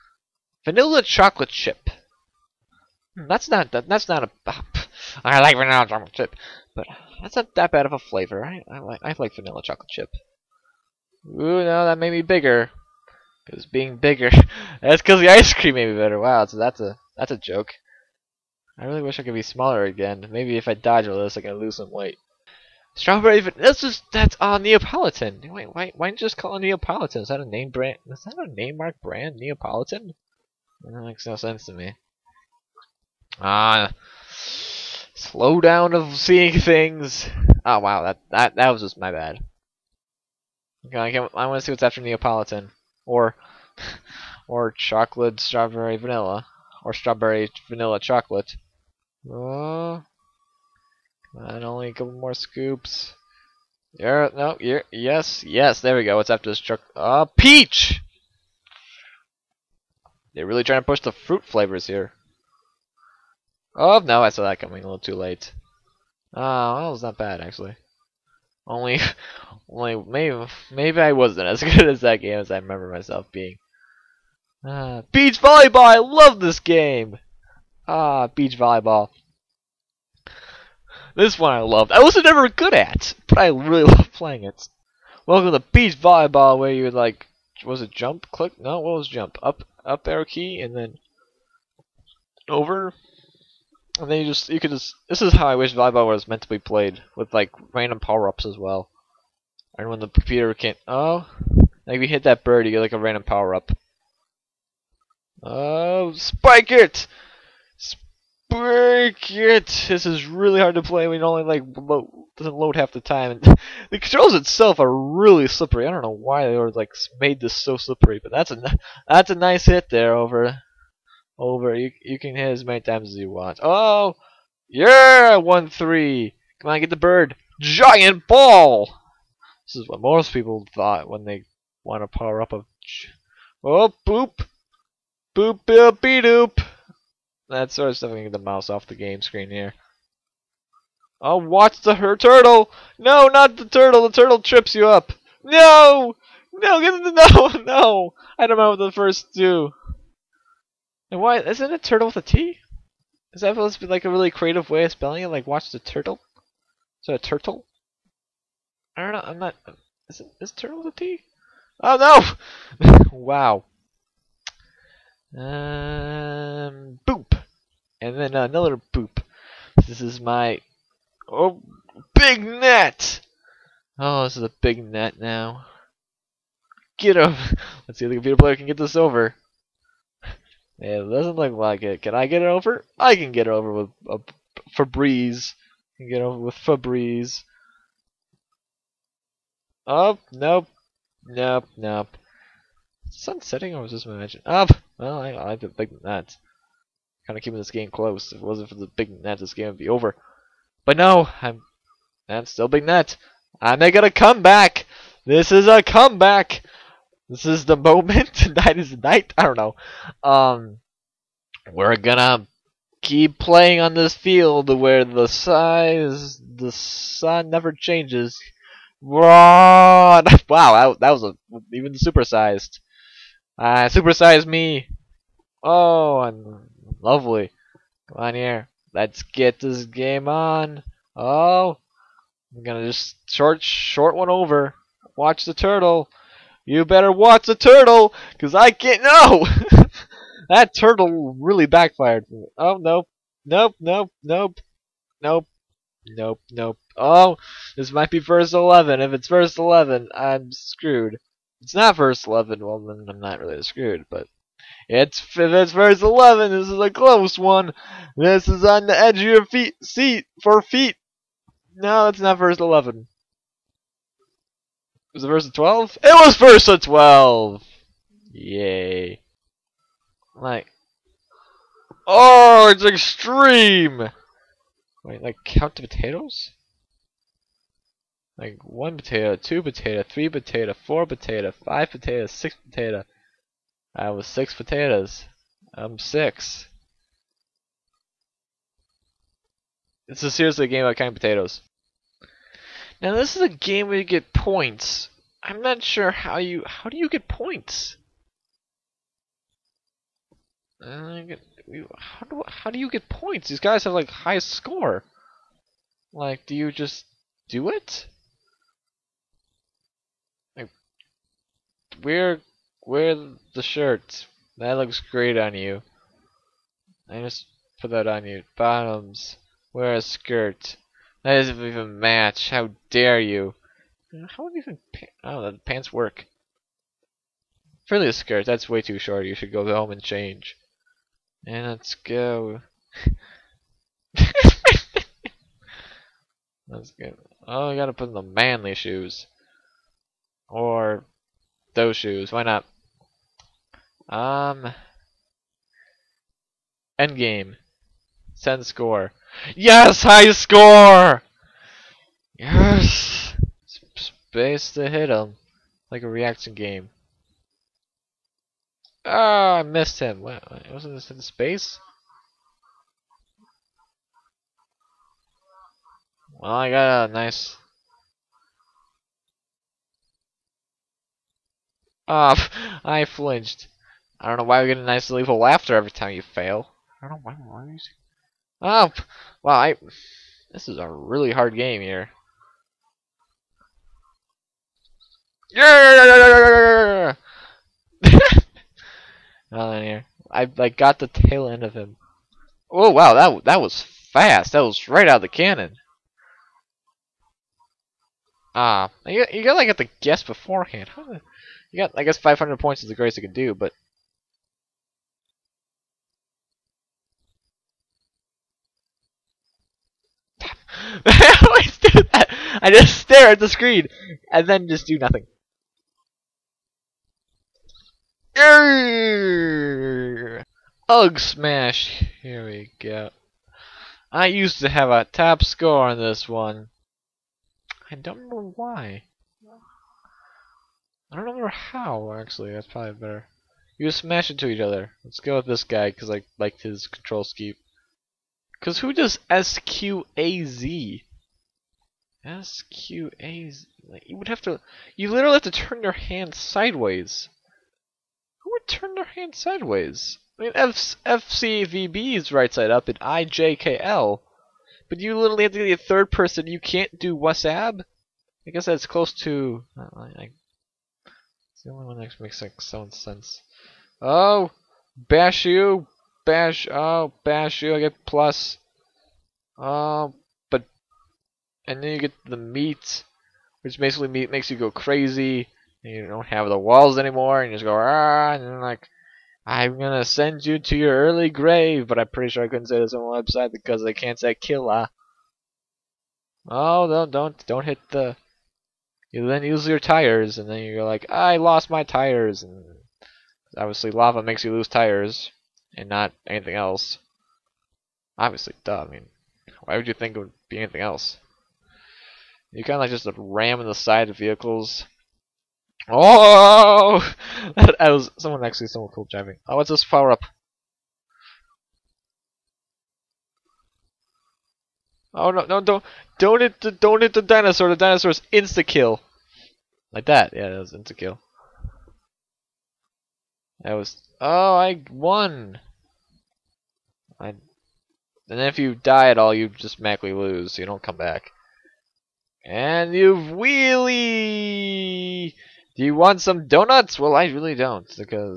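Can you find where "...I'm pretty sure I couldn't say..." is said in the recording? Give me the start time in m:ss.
8:01.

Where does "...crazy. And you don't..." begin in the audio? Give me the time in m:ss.
7:54.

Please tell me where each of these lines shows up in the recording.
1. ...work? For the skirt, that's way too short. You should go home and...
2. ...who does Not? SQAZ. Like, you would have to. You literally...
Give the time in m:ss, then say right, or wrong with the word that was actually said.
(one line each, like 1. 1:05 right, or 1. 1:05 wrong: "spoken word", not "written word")
1. 5:25 right
2. 7:18 wrong: "SQAZ", not "Not".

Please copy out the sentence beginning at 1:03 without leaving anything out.
Oh, no, I saw that coming a little too late.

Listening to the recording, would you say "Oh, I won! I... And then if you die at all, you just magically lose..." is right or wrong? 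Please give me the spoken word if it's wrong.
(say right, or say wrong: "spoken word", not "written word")
right.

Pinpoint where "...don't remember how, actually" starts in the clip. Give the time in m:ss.
7:11.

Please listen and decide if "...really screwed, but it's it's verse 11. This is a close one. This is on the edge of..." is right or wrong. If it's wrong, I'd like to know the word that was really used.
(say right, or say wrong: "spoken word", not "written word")
right.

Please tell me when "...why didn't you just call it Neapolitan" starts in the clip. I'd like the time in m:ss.
0:25.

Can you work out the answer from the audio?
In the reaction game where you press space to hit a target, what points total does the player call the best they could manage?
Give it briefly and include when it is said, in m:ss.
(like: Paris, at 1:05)
500 points, at 6:42.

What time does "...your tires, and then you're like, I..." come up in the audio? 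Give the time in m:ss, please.
8:09.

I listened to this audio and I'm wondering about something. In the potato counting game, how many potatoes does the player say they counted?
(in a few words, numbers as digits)
6.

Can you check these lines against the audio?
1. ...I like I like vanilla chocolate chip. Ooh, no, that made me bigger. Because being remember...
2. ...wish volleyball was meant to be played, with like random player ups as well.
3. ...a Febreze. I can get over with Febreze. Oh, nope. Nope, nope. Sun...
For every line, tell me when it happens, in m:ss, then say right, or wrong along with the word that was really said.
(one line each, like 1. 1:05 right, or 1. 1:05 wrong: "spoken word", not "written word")
1. 0:08 wrong: "bigger", not "remember"
2. 1:35 wrong: "power", not "player"
3. 3:04 right.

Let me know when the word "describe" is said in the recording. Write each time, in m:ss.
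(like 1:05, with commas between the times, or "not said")
not said.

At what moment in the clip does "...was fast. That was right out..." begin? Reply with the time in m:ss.
6:33.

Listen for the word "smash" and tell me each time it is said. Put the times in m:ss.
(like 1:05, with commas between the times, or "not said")
7:01, 7:13.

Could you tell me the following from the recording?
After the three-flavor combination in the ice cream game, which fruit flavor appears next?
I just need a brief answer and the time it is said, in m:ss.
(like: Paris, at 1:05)
Peach, at 0:57.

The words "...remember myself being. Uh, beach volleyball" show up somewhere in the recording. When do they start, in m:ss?
1:12.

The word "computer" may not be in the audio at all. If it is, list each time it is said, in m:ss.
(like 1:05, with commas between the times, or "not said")
1:40, 2:58.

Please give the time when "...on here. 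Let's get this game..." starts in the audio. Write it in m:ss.
3:48.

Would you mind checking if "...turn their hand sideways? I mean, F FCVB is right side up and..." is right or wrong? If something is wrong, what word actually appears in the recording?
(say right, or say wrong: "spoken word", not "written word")
right.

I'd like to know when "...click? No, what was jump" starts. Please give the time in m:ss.
1:28.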